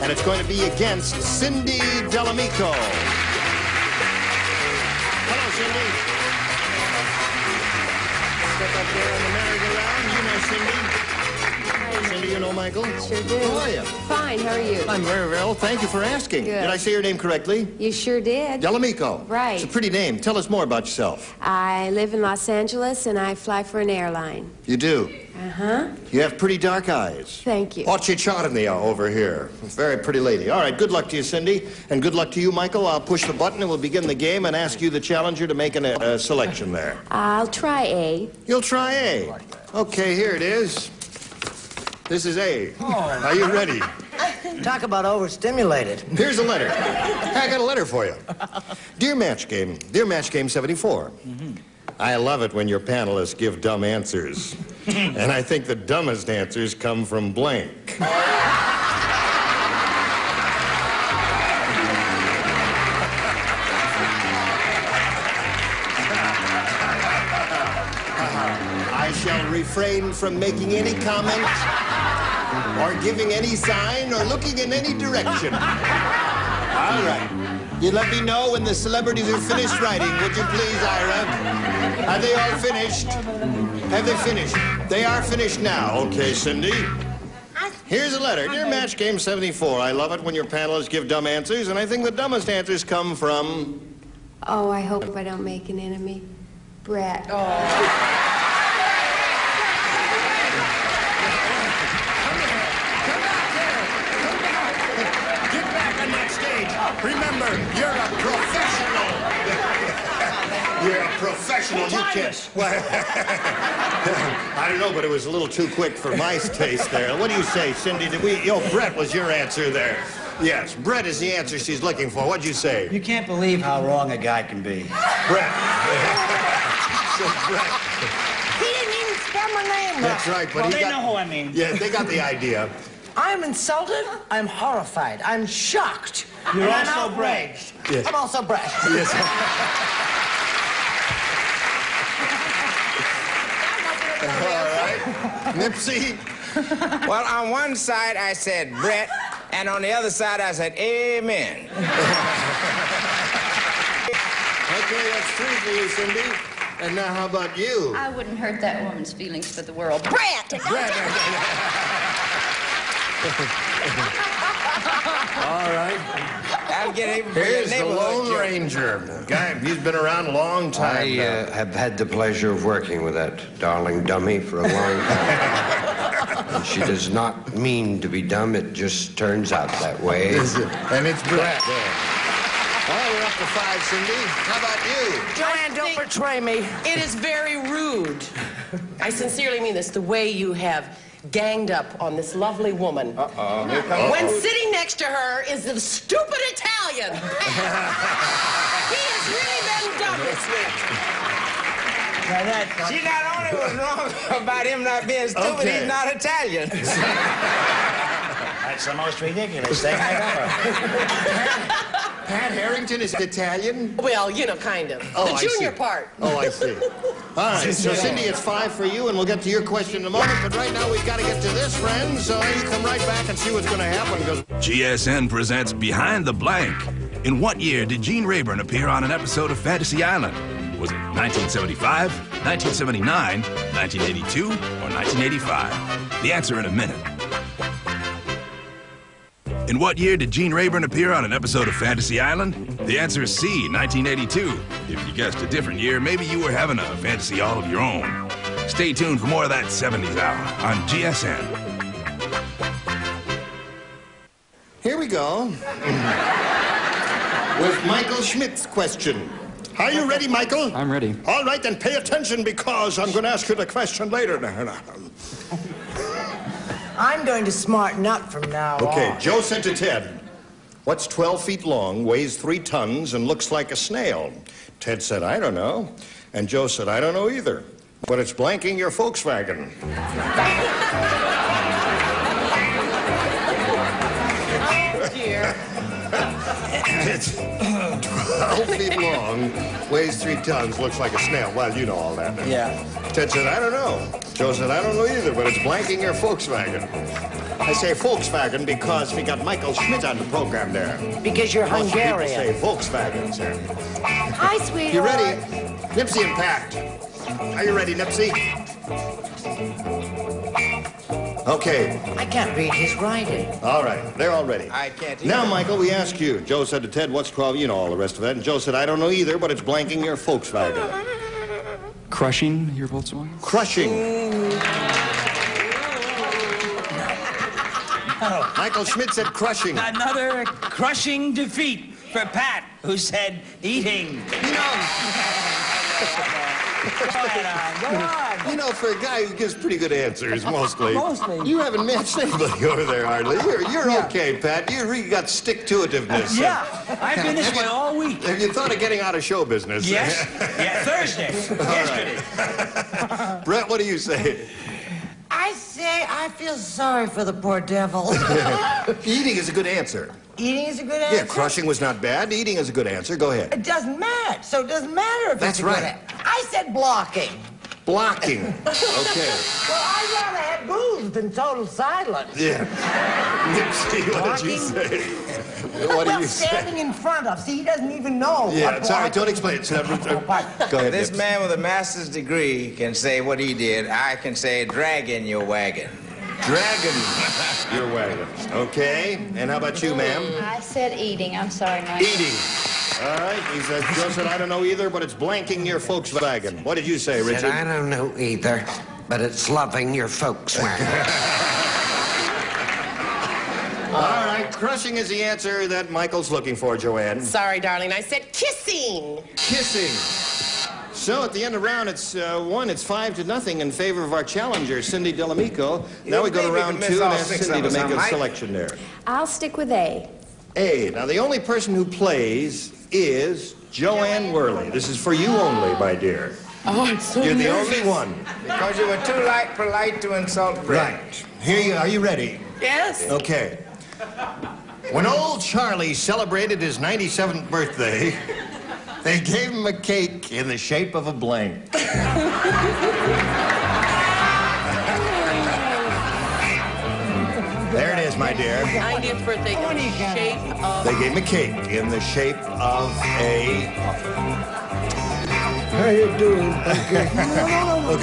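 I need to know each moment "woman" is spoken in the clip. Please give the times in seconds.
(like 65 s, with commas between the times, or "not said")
158 s, 192 s.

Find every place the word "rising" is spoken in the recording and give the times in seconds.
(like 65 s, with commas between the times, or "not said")
not said.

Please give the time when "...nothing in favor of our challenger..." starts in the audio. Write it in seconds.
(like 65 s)
413 s.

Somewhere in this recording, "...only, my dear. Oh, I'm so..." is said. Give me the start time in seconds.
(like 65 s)
425 s.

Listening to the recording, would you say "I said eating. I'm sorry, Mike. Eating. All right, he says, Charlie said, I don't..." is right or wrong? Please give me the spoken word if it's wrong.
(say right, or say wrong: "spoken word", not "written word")
wrong: "Joe", not "Charlie".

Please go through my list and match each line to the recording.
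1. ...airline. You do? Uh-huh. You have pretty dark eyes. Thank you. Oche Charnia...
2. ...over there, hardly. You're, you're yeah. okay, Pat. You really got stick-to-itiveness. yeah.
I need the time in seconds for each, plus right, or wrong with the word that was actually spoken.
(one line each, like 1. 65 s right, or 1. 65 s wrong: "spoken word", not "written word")
1. 23 s right
2. 342 s right.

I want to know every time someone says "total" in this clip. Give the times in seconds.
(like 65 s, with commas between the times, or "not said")
371 s.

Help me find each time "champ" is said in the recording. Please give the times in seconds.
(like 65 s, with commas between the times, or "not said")
not said.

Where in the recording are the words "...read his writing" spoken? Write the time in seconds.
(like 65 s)
312 s.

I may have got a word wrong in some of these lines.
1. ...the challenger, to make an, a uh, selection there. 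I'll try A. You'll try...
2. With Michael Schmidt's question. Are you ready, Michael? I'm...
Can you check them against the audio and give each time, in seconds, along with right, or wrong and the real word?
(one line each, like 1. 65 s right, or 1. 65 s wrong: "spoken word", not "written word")
1. 34 s right
2. 257 s right.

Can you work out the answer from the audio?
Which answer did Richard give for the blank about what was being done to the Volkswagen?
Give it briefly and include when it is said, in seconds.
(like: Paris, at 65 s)
Loving, at 399 s.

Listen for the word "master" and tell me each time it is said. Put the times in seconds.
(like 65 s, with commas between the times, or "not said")
381 s.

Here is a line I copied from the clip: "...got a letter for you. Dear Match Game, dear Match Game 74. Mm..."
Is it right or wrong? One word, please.
right.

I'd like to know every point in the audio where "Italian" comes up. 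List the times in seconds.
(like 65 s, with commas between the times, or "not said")
196 s, 206 s, 213 s.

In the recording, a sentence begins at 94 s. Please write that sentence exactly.
Oh, I hope I don't make an enemy.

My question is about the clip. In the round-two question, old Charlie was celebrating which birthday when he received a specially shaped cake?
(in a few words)
97th.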